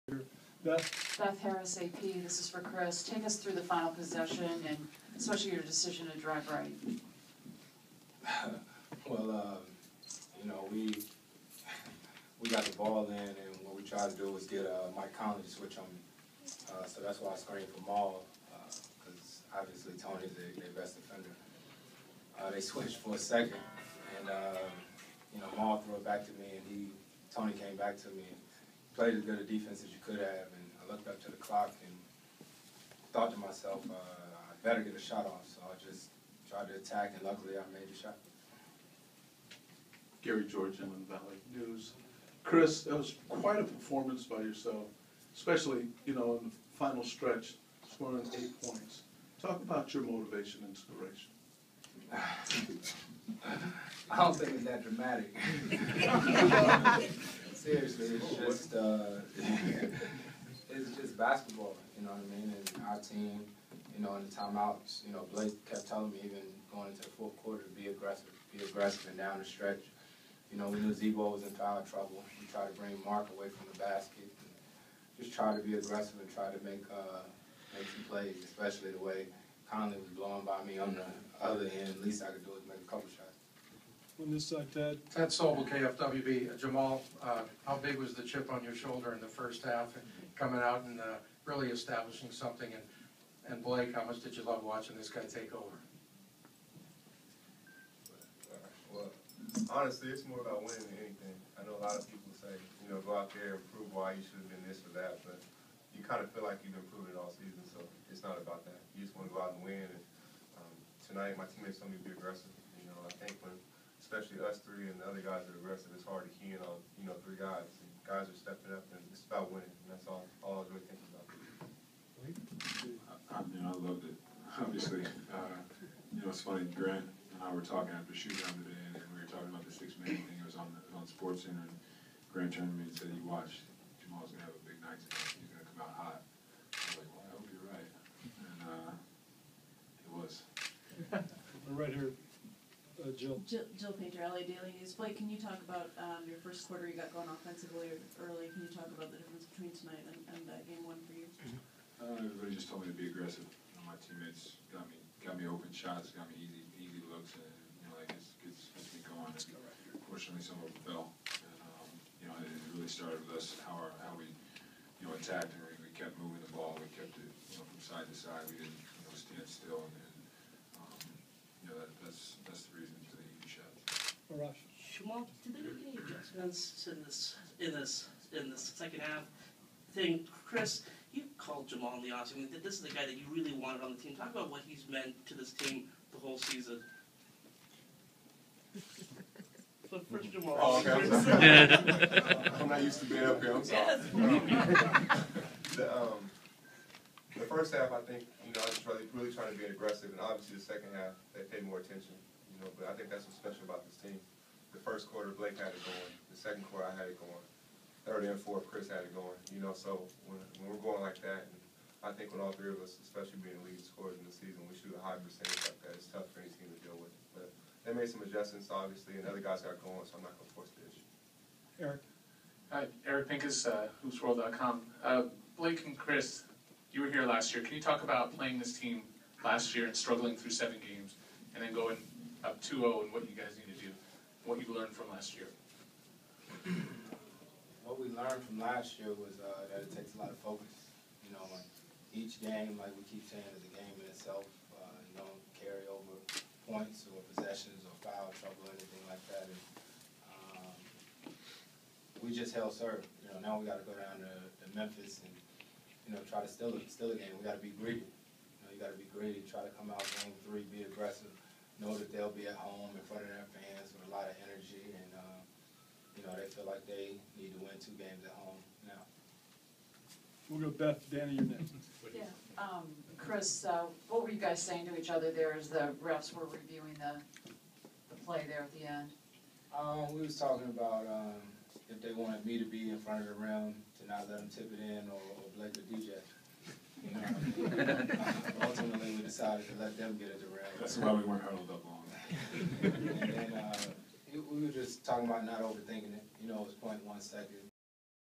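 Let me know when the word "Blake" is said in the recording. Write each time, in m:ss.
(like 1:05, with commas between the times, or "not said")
1:05, 1:33, 2:24, 3:25, 3:45.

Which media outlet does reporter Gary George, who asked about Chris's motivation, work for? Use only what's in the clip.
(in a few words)
Inland Valley News.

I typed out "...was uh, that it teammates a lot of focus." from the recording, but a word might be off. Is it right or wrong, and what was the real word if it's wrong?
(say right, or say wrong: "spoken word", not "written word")
wrong: "takes", not "teammates".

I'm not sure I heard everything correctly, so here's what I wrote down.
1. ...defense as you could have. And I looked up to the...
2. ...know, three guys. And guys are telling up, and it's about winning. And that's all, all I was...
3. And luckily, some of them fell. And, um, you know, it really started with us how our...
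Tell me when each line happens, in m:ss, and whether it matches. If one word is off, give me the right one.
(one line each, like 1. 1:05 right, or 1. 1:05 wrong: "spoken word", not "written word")
1. 0:29 right
2. 1:57 wrong: "stepping", not "telling"
3. 2:39 wrong: "fortunately", not "luckily".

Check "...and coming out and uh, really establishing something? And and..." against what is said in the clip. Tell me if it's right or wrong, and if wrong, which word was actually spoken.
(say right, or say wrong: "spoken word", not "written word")
right.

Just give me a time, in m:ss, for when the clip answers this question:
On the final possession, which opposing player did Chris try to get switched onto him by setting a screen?
0:14.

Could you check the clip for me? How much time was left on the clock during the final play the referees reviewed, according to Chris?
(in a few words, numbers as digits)
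0.1 second.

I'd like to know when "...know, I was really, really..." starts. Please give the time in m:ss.
3:18.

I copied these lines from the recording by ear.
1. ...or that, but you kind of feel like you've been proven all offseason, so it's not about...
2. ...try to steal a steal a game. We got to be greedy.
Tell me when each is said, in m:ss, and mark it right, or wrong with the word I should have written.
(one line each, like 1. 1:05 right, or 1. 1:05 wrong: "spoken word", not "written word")
1. 1:44 wrong: "season", not "offseason"
2. 4:16 right.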